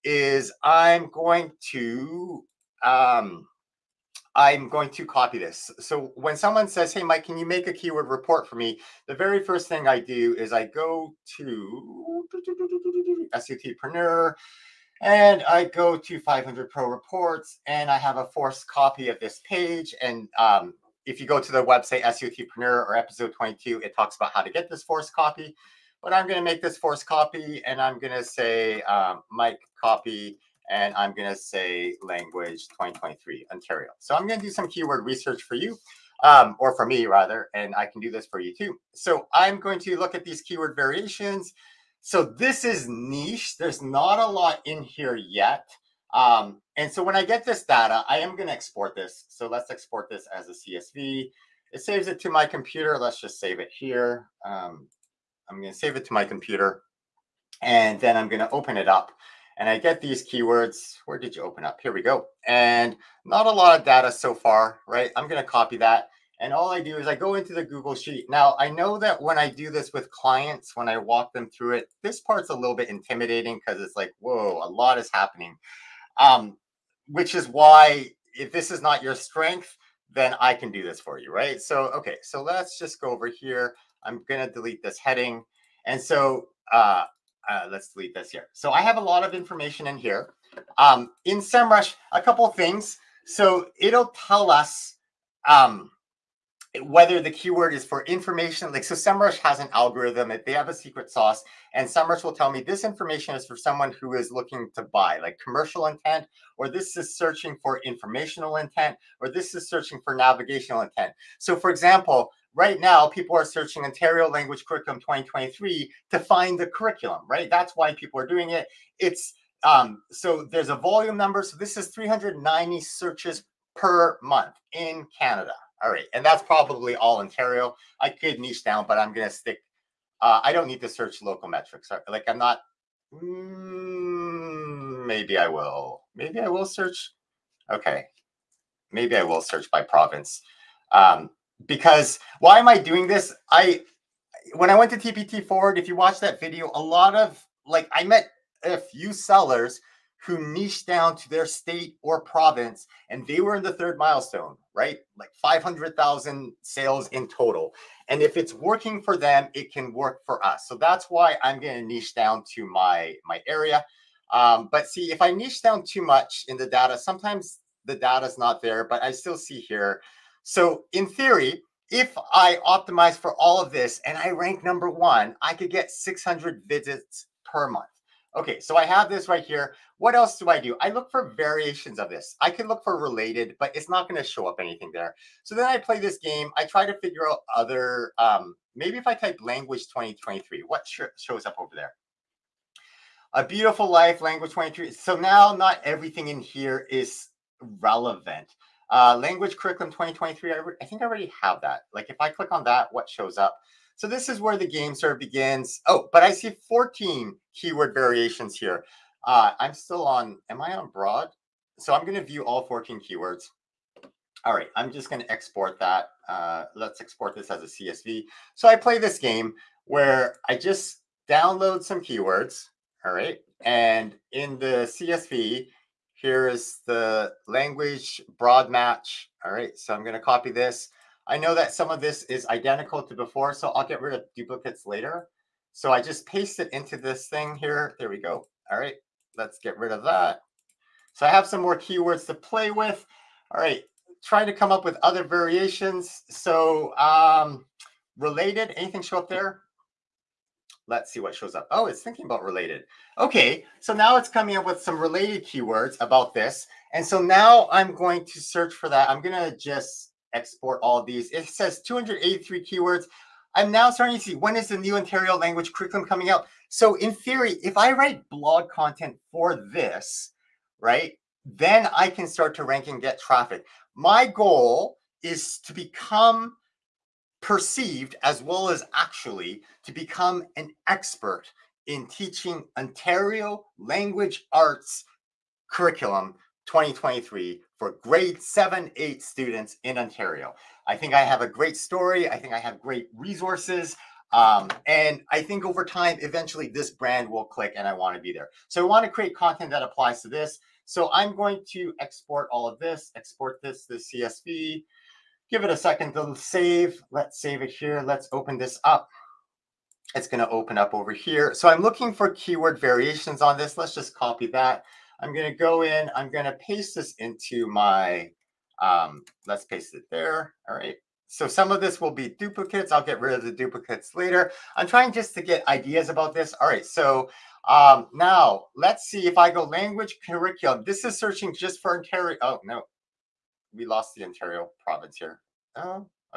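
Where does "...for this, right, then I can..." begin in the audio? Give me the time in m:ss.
4:29.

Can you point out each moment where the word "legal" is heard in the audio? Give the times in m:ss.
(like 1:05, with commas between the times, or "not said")
not said.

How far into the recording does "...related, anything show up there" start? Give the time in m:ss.
4:08.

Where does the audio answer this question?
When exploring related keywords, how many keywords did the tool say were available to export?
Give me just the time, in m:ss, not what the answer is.
4:21.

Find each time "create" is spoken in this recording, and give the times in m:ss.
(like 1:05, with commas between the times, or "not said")
4:59.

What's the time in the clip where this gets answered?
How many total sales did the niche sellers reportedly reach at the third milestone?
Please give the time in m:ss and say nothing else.
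2:35.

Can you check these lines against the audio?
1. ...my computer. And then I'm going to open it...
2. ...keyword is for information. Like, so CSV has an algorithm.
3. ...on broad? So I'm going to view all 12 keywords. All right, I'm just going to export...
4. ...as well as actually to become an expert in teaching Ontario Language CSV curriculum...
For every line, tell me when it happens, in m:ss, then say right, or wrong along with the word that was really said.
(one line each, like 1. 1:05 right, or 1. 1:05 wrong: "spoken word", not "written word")
1. 0:56 right
2. 1:37 wrong: "SEMrush", not "CSV"
3. 3:30 wrong: "14", not "12"
4. 4:38 wrong: "Arts", not "CSV".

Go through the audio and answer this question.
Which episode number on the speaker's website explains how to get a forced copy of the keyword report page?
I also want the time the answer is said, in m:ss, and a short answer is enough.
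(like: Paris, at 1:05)
22, at 0:22.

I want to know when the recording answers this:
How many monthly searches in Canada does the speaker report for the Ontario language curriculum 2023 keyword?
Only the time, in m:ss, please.
2:01.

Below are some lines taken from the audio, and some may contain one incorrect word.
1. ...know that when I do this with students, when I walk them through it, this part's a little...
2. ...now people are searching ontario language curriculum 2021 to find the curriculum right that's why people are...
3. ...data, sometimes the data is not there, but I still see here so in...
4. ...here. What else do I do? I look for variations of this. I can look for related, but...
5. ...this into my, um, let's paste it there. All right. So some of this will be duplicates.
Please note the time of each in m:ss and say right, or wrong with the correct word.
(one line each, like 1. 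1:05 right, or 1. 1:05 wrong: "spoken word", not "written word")
1. 1:08 wrong: "clients", not "students"
2. 1:52 wrong: "2023", not "2021"
3. 2:46 right
4. 2:59 right
5. 5:16 right.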